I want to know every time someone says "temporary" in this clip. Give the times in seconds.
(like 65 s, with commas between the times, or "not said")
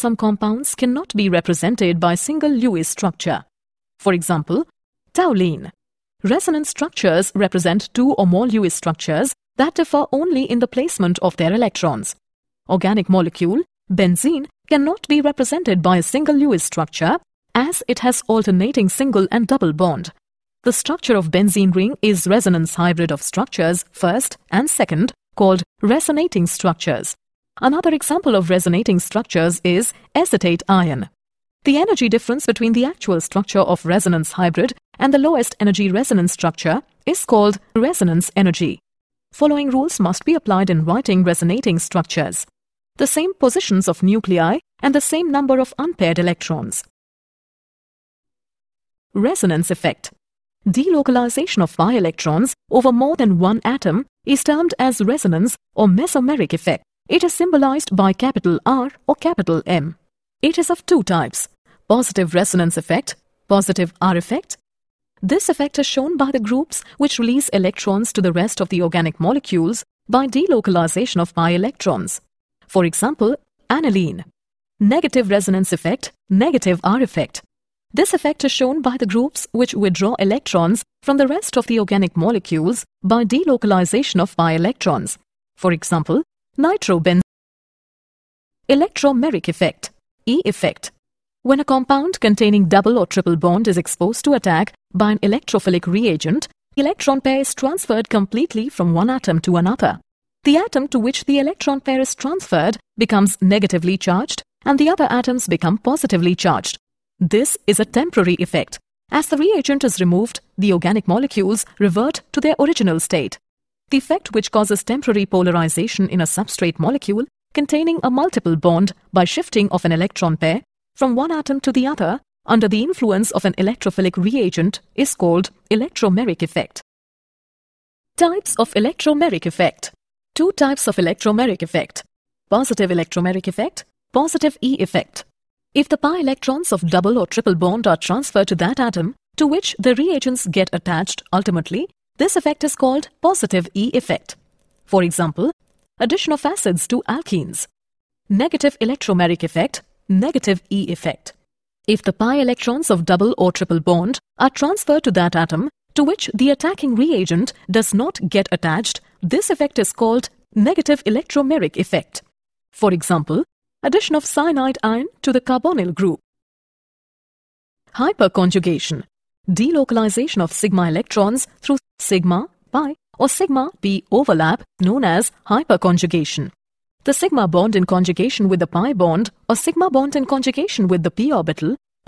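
107 s, 114 s.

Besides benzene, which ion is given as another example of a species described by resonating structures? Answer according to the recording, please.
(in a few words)
acetate ion.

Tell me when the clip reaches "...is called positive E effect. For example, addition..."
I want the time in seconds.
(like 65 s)
142 s.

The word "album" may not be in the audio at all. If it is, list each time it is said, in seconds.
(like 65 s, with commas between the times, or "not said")
not said.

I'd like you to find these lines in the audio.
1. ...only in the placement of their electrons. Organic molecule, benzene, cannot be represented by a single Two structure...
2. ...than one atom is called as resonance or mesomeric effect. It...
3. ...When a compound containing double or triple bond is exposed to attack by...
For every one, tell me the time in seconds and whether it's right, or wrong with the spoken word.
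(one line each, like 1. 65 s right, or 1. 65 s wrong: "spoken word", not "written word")
1. 10 s wrong: "Lewis", not "Two"
2. 53 s wrong: "termed", not "called"
3. 91 s right.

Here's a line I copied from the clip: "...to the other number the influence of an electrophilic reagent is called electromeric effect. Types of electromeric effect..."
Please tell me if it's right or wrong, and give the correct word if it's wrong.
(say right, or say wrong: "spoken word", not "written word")
wrong: "under", not "number".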